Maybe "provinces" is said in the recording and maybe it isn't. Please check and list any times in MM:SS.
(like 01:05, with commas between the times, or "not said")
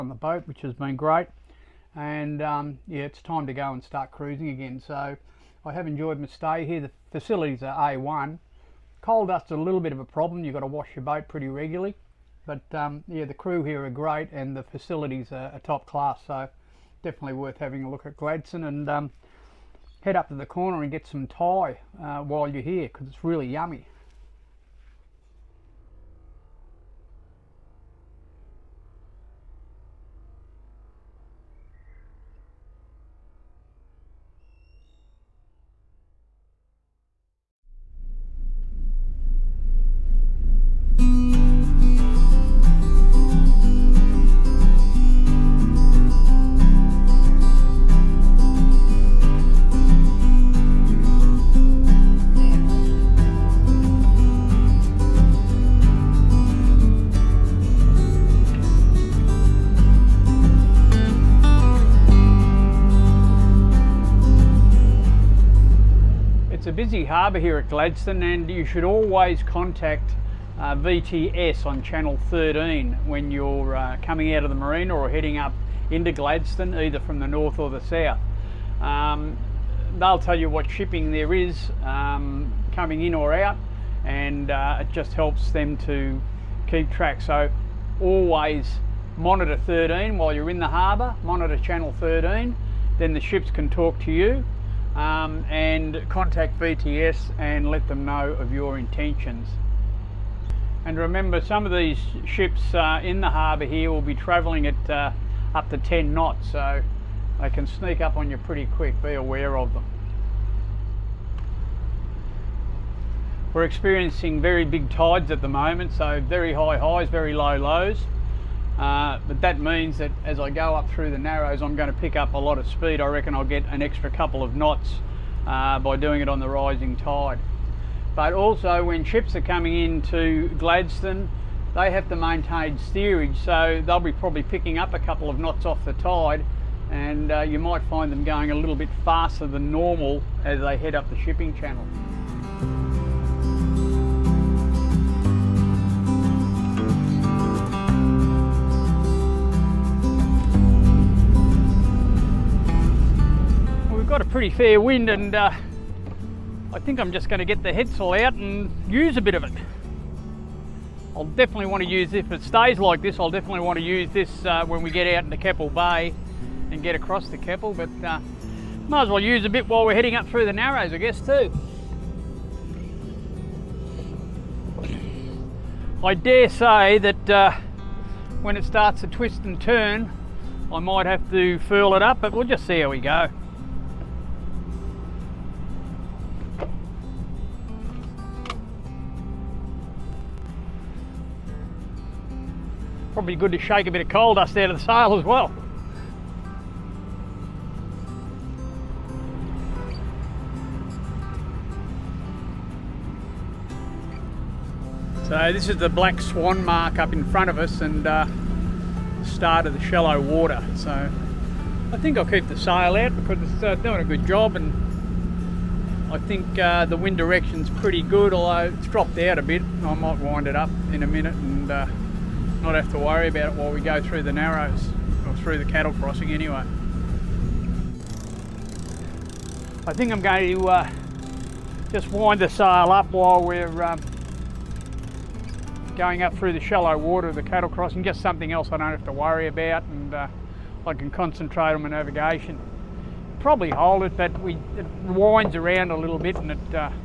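not said.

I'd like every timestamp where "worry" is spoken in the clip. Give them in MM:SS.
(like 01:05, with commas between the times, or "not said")
03:42, 03:59.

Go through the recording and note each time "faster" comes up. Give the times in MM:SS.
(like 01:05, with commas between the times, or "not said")
02:19.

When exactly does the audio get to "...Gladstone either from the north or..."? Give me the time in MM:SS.
01:16.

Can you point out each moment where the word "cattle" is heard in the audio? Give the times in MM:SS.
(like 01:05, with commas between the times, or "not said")
03:45, 03:57.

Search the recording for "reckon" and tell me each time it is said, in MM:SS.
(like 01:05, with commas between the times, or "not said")
02:03.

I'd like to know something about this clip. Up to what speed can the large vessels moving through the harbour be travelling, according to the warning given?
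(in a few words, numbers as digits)
10 knots.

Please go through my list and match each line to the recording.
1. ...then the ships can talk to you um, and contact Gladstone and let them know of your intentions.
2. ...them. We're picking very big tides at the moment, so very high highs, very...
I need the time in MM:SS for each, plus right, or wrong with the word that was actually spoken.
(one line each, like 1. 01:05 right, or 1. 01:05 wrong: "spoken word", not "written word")
1. 01:32 wrong: "VTS", not "Gladstone"
2. 01:49 wrong: "experiencing", not "picking".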